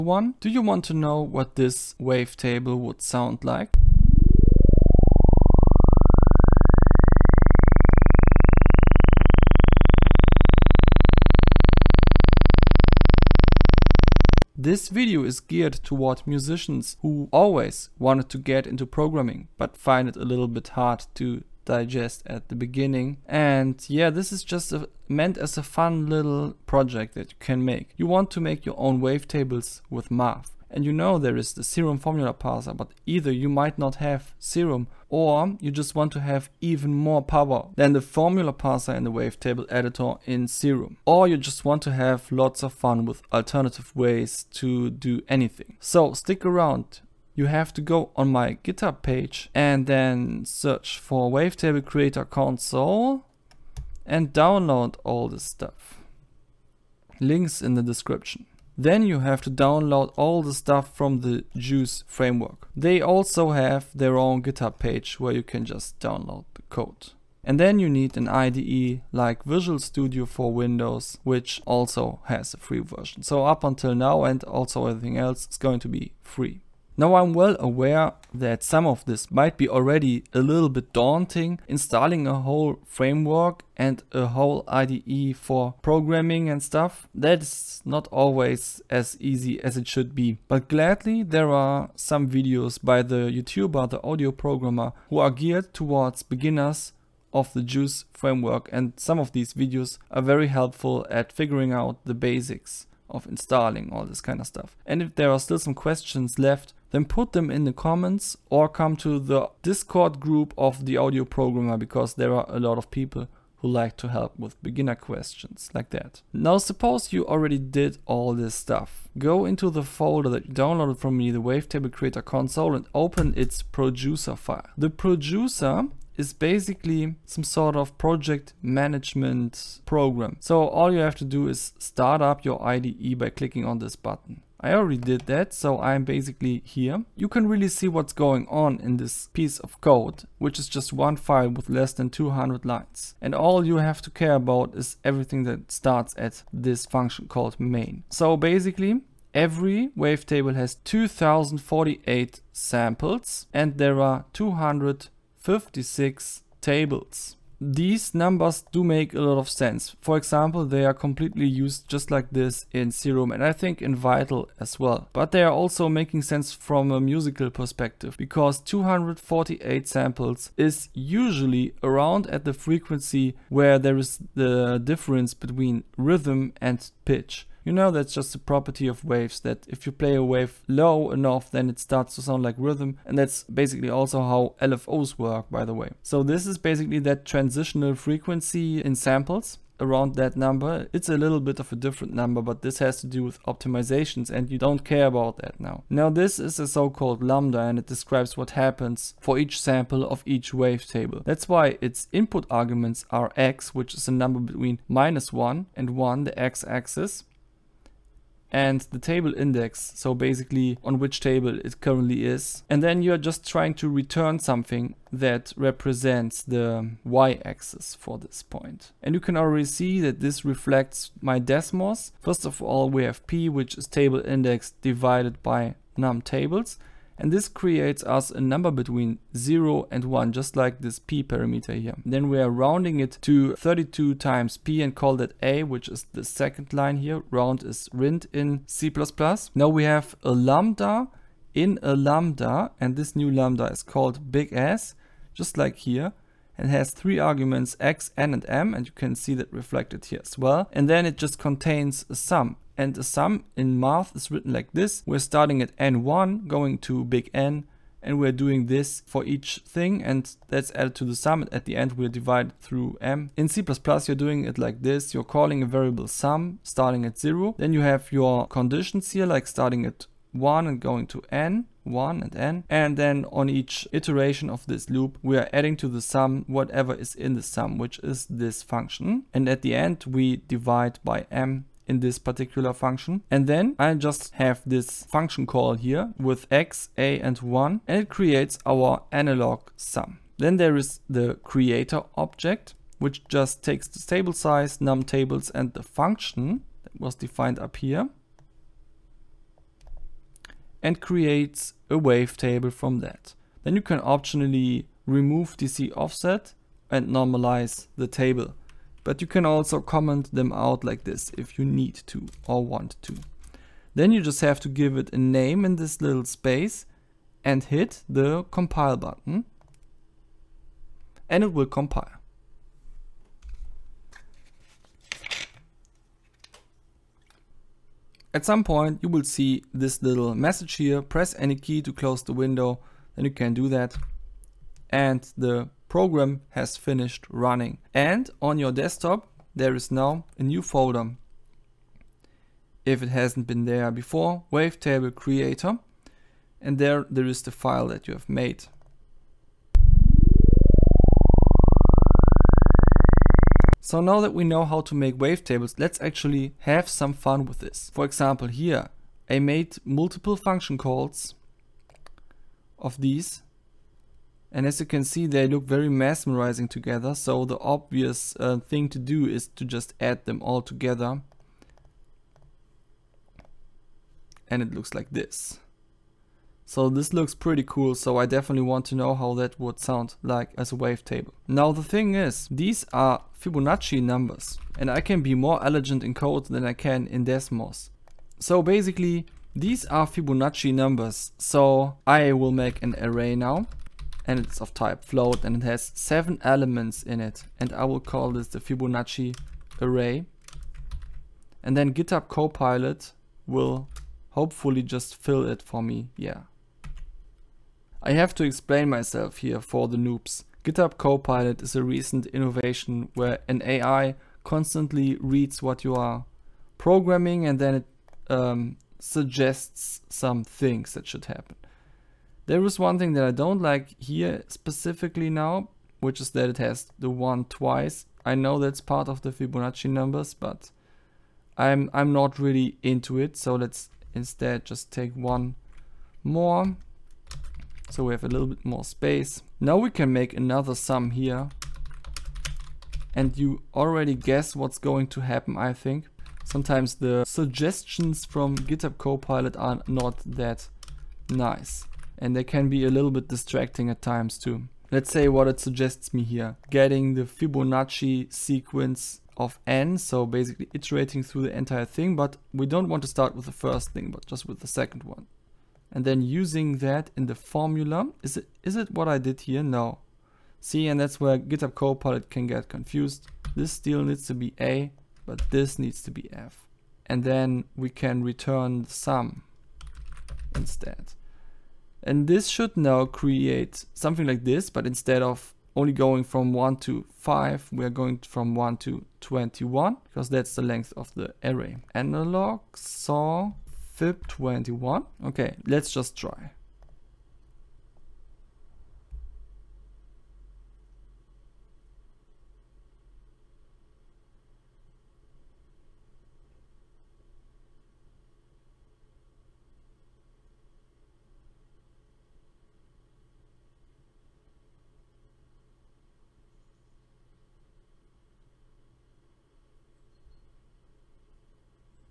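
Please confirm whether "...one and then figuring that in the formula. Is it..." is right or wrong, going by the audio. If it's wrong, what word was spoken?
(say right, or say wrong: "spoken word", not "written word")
wrong: "using", not "figuring".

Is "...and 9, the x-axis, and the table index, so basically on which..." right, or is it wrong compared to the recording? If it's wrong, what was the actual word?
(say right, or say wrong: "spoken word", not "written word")
wrong: "1", not "9".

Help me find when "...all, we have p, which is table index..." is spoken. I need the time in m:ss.
3:42.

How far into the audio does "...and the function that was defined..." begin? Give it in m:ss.
4:55.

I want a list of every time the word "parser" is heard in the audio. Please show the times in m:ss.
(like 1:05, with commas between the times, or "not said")
0:32, 0:38.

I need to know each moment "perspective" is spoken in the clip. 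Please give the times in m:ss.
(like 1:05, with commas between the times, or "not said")
2:47.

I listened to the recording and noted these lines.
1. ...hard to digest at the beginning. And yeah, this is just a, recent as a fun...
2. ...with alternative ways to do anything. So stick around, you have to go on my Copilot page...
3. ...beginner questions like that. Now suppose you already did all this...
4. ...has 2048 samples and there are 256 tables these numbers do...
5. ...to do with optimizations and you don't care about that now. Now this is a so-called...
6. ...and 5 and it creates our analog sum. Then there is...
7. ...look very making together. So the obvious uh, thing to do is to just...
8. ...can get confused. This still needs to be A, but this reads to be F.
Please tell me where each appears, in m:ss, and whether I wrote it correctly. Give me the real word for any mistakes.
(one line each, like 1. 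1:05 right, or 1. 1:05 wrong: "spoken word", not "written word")
1. 0:20 wrong: "meant", not "recent"
2. 0:43 wrong: "GitHub", not "Copilot"
3. 1:54 right
4. 2:30 right
5. 3:13 right
6. 4:47 wrong: "1", not "5"
7. 6:05 wrong: "mesmerizing", not "making"
8. 7:52 wrong: "needs", not "reads".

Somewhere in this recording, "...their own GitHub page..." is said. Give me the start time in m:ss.
1:03.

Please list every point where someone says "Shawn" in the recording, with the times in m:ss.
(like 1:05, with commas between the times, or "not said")
not said.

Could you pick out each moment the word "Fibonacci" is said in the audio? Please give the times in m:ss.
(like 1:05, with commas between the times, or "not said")
6:23, 6:30, 6:38, 7:09, 7:37.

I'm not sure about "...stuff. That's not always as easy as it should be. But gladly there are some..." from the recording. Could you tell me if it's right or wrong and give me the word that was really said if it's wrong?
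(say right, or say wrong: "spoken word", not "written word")
right.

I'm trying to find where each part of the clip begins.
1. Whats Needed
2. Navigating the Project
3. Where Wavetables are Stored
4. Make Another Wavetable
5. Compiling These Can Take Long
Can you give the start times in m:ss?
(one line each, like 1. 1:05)
1. 0:47
2. 1:55
3. 5:37
4. 5:52
5. 8:14.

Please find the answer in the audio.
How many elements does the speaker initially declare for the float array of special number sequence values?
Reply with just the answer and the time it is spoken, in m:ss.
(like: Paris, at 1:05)
7, at 6:35.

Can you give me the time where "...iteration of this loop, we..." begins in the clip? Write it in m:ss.
4:33.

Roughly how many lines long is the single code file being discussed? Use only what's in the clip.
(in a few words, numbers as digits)
less than 200.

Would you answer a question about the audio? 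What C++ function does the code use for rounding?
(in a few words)
rint.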